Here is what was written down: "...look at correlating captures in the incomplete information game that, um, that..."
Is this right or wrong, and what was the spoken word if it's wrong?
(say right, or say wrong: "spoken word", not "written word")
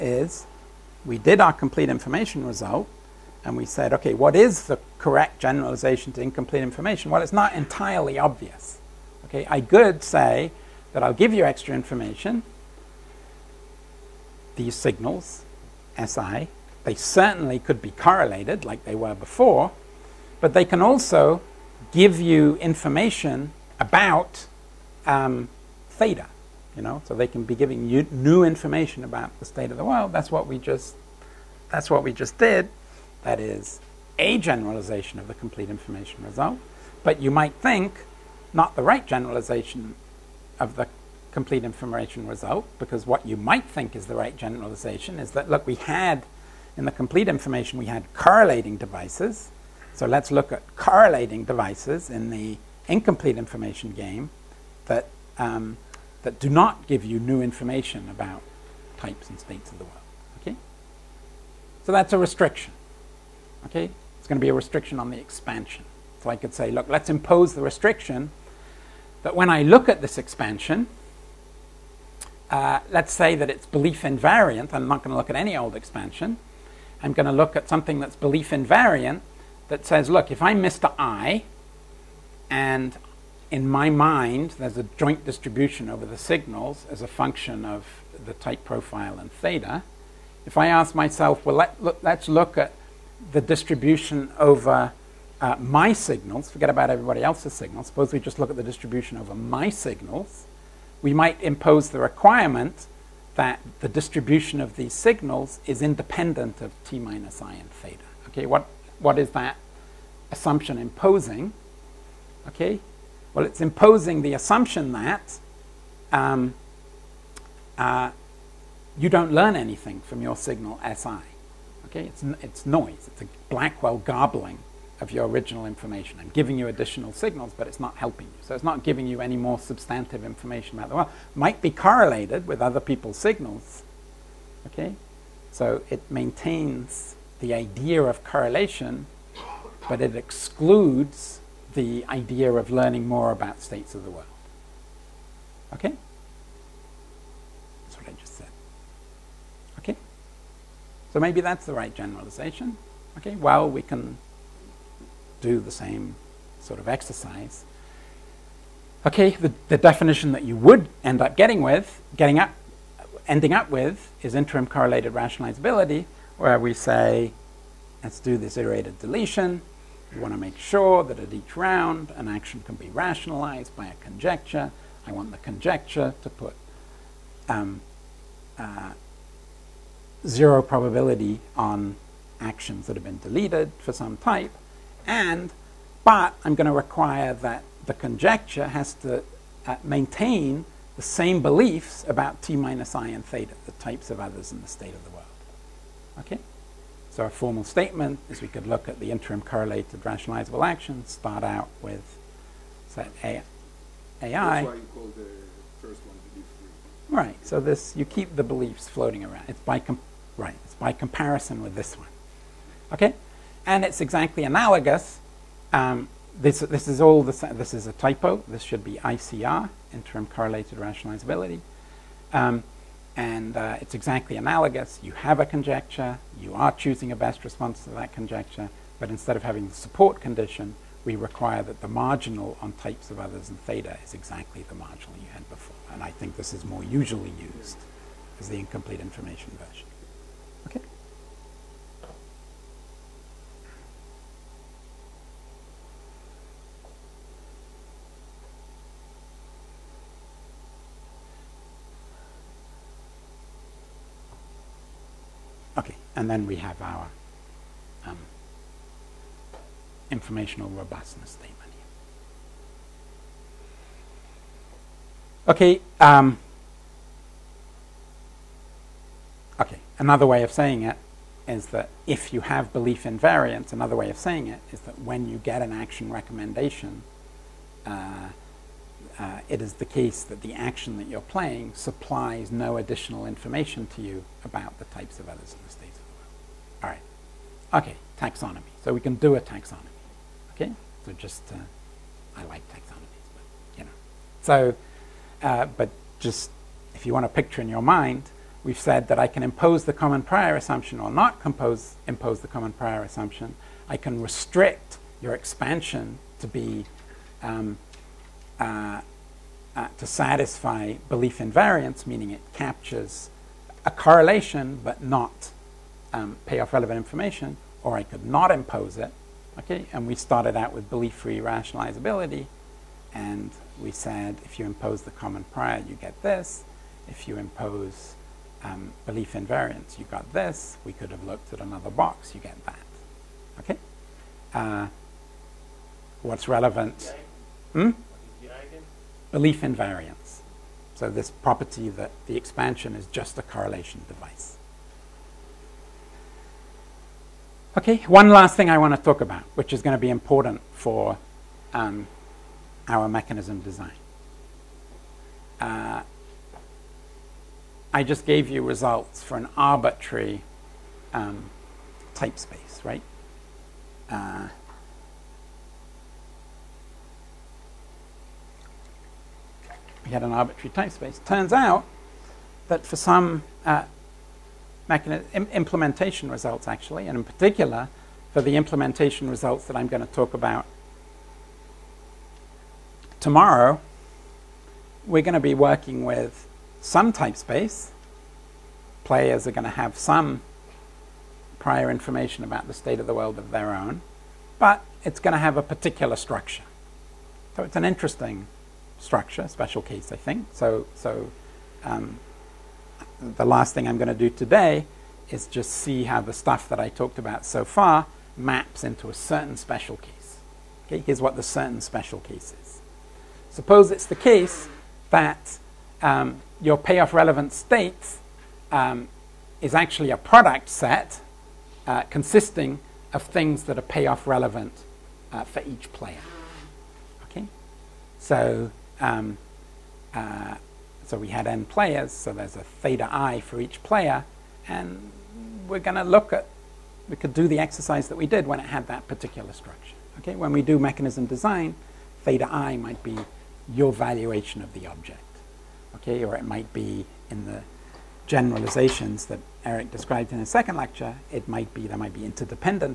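wrong: "devices", not "captures".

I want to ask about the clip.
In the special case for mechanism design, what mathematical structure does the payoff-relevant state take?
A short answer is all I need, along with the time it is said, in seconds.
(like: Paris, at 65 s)
a product set, at 420 s.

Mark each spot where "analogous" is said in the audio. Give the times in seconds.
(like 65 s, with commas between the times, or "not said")
214 s, 224 s.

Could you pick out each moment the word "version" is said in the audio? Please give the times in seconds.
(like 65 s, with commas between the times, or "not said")
239 s.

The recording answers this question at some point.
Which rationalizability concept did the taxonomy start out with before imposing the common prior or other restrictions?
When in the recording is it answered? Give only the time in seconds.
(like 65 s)
320 s.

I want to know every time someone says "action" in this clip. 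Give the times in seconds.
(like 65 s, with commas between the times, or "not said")
172 s, 182 s, 200 s, 275 s, 280 s.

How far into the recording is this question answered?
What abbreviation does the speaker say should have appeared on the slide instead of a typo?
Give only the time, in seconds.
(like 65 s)
218 s.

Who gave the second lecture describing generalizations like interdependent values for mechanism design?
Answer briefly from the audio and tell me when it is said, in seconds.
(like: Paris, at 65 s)
Eric, at 449 s.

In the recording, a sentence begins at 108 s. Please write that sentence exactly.
Okay, what, what is that assumption imposing?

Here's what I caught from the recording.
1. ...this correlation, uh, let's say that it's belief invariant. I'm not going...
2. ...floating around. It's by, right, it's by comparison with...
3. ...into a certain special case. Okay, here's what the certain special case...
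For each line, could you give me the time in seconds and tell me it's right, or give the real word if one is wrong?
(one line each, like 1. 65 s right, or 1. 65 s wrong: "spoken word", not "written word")
1. 69 s wrong: "expansion", not "correlation"
2. 208 s right
3. 408 s right.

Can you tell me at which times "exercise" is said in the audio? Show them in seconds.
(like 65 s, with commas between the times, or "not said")
156 s, 437 s.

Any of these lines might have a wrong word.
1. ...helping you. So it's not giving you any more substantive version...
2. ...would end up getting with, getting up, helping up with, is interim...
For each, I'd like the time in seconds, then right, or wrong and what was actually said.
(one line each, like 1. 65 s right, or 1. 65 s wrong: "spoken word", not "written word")
1. 127 s wrong: "information", not "version"
2. 160 s wrong: "ending", not "helping".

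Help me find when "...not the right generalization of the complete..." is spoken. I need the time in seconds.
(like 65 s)
38 s.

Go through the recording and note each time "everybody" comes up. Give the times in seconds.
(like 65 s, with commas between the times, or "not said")
96 s.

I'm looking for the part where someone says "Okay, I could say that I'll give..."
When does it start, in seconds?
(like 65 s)
9 s.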